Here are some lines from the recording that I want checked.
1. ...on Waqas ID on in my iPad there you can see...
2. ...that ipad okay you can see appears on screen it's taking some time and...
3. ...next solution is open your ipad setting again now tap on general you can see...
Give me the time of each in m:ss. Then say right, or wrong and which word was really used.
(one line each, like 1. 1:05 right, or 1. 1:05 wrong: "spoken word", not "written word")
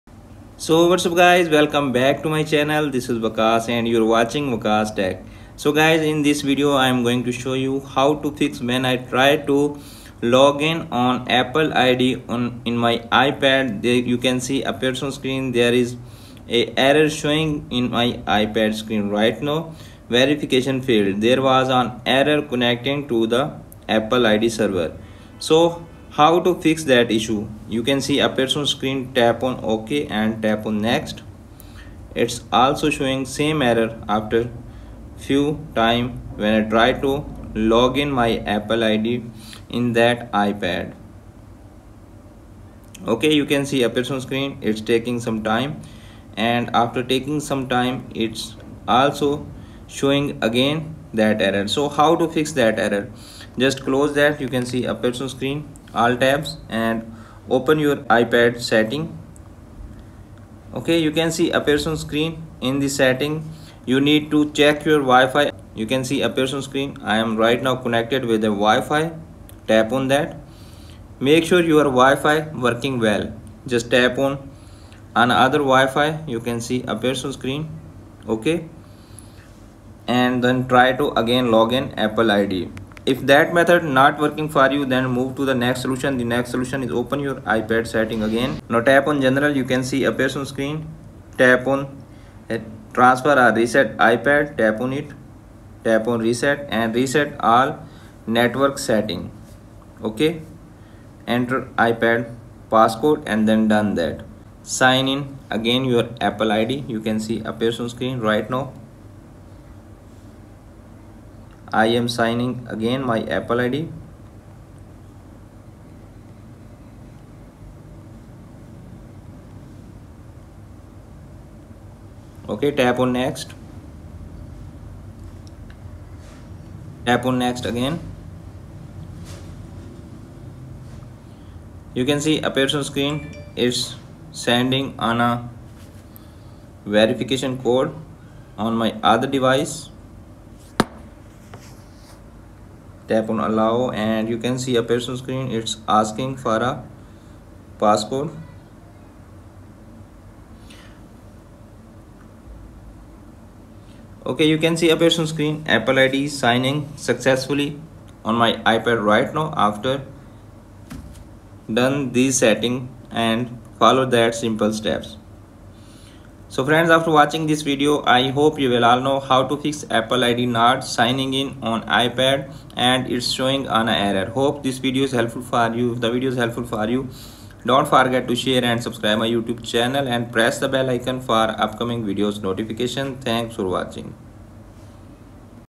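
1. 0:10 wrong: "Apple", not "Waqas"
2. 0:39 right
3. 1:26 right.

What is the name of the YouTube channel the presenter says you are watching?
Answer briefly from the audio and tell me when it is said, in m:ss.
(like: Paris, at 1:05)
Waqas Tech, at 0:04.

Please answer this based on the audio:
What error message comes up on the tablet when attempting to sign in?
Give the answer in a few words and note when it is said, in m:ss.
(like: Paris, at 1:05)
verification failed, at 0:20.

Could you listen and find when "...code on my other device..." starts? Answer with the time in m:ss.
2:17.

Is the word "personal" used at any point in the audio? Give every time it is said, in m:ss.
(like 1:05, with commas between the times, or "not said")
2:24, 2:35.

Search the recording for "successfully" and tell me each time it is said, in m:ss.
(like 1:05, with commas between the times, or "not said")
2:37.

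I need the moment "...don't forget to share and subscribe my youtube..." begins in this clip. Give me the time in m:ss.
2:57.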